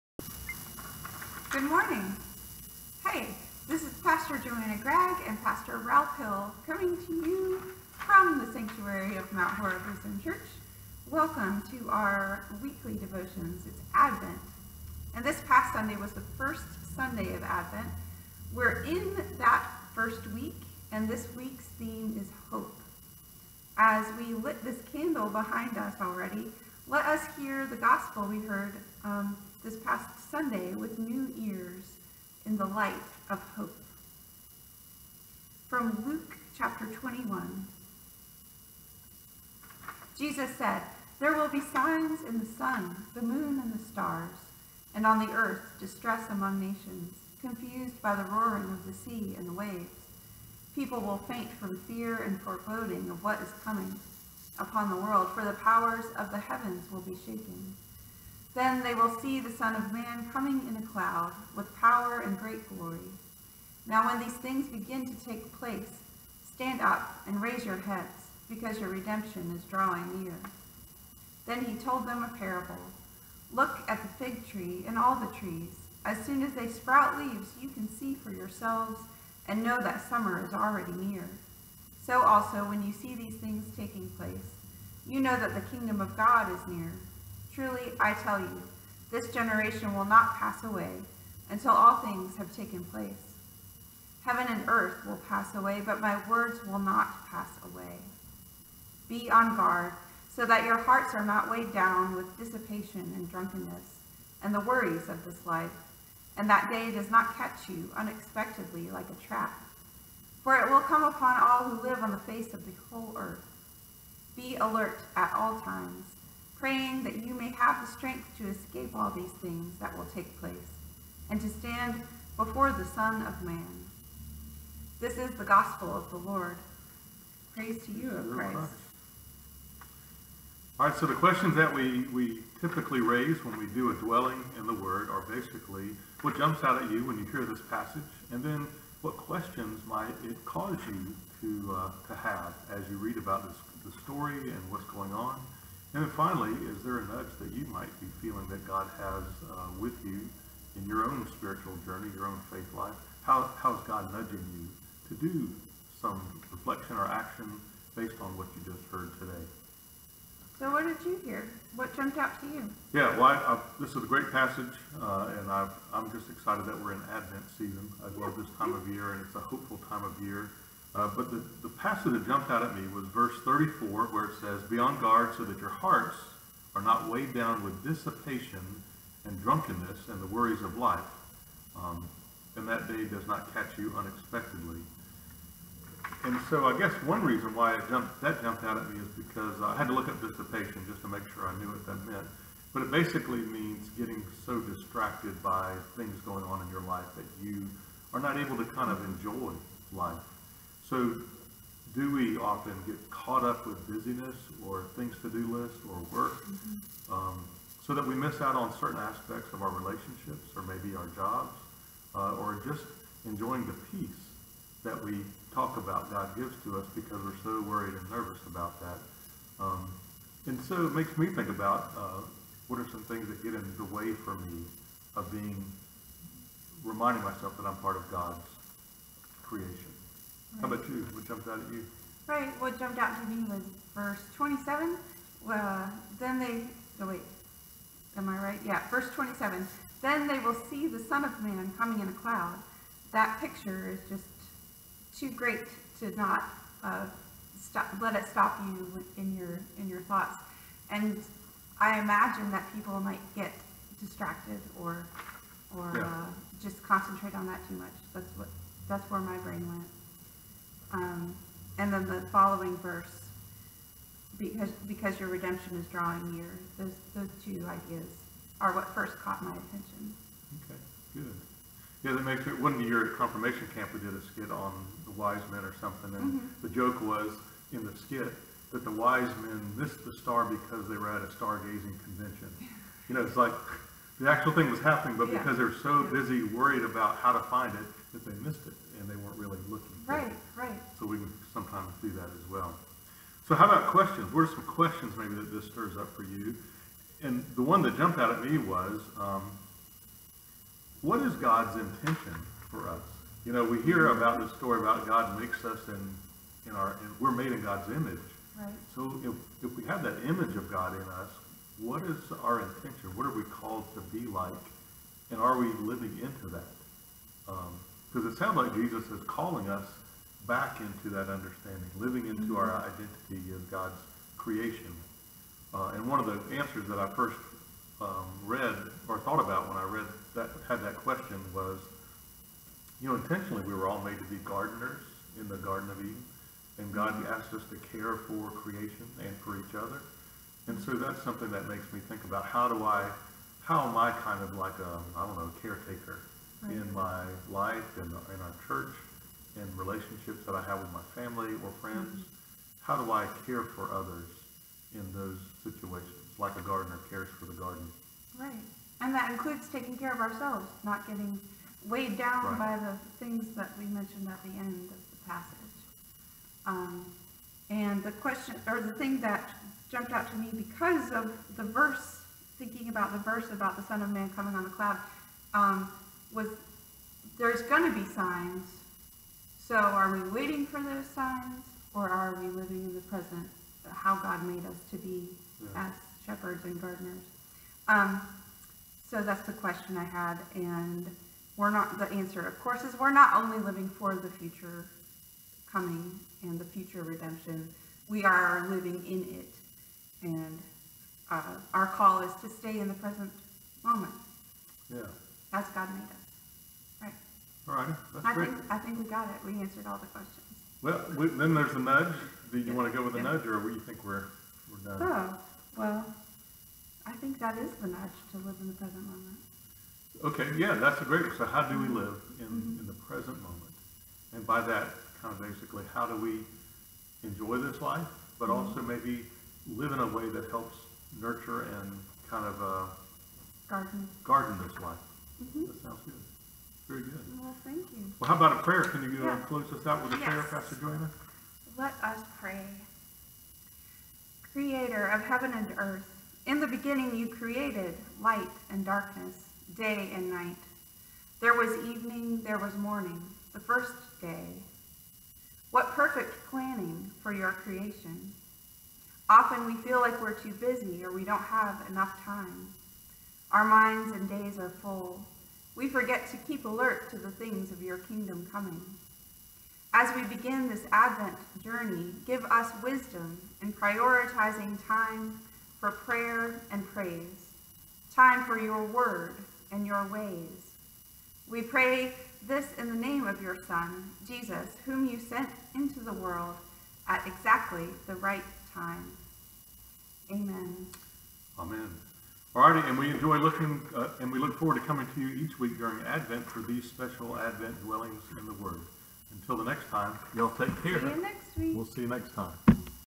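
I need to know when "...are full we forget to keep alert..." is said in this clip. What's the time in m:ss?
7:44.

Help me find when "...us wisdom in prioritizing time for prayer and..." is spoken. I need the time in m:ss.
7:52.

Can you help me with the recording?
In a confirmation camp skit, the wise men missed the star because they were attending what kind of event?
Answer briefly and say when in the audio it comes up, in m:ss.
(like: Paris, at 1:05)
stargazing convention, at 4:41.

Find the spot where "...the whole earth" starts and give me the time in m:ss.
1:52.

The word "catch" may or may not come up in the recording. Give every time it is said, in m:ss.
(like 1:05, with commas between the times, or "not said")
1:47, 3:03.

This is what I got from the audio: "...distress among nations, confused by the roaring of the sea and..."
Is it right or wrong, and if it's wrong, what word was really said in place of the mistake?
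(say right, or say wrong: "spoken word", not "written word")
right.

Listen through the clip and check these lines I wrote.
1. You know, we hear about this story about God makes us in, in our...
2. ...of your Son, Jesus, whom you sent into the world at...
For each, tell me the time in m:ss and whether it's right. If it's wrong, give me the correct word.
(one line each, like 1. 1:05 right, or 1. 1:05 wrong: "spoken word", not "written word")
1. 5:03 right
2. 8:03 right.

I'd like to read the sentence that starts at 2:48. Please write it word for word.
I love this time of year, and it's a hopeful time of year.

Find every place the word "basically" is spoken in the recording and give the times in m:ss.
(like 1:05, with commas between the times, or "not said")
2:15, 3:12, 7:05.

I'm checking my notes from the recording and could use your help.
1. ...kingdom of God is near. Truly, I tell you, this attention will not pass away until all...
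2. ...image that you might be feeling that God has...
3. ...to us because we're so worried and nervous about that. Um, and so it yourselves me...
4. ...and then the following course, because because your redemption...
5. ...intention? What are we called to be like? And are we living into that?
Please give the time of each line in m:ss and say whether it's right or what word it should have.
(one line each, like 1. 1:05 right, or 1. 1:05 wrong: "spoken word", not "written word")
1. 1:25 wrong: "generation", not "attention"
2. 2:27 wrong: "nudge", not "image"
3. 3:36 wrong: "makes", not "yourselves"
4. 4:21 wrong: "verse", not "course"
5. 5:12 right.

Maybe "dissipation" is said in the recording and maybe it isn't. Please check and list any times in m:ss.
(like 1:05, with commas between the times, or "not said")
1:42, 2:57, 3:10.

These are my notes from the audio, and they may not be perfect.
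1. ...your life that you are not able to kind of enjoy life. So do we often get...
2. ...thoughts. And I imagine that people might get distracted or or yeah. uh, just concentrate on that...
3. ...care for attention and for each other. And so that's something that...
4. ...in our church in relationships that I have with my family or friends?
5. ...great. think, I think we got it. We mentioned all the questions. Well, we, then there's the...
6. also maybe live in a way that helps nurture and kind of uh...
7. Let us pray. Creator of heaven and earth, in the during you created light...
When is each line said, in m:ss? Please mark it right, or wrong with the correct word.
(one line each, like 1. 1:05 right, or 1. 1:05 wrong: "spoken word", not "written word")
1. 3:16 right
2. 4:10 right
3. 5:37 wrong: "creation", not "attention"
4. 5:48 right
5. 6:48 wrong: "answered", not "mentioned"
6. 7:08 right
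7. 7:21 wrong: "beginning", not "during".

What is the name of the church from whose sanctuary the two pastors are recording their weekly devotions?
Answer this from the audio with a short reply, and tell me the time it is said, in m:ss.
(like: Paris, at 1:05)
Mount Horeb Lutheran Church, at 0:09.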